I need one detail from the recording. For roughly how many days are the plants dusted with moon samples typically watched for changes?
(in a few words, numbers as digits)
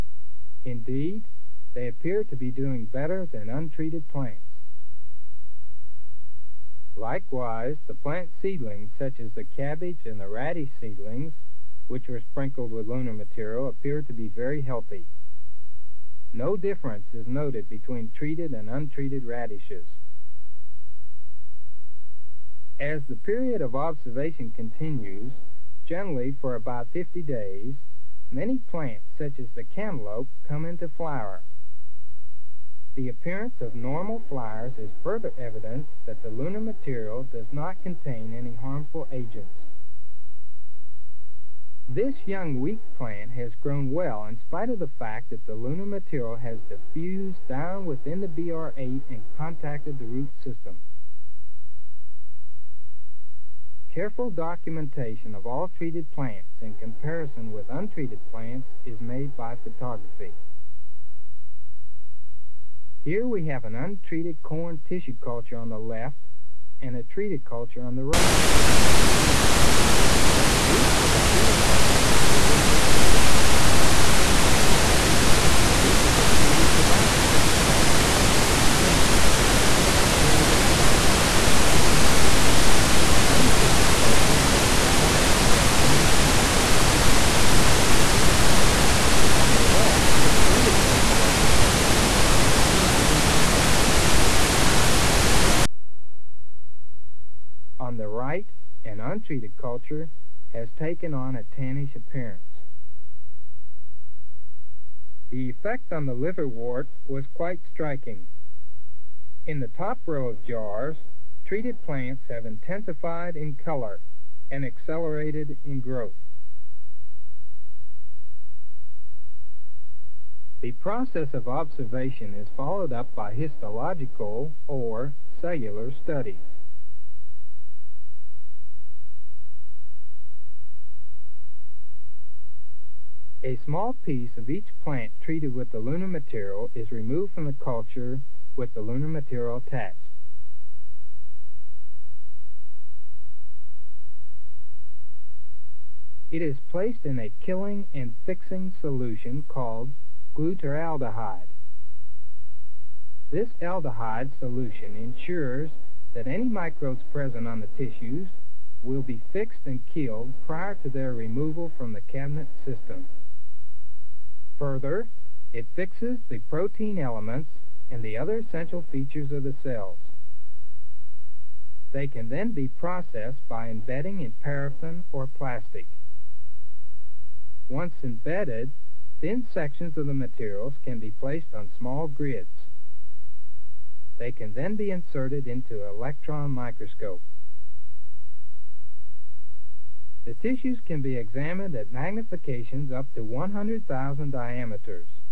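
50 days.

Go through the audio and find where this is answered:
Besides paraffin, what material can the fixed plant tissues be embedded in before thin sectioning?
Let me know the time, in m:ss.
2:55.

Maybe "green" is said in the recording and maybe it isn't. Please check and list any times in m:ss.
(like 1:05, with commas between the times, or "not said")
1:18, 1:32.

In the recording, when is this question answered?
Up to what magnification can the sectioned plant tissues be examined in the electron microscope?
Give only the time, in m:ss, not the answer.
3:13.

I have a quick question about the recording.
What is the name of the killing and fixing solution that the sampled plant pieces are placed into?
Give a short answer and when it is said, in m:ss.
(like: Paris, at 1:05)
glutaraldehyde, at 2:30.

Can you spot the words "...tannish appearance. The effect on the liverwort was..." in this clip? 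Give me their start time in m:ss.
1:41.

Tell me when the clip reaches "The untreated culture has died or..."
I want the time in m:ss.
1:23.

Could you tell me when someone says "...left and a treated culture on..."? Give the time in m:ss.
1:05.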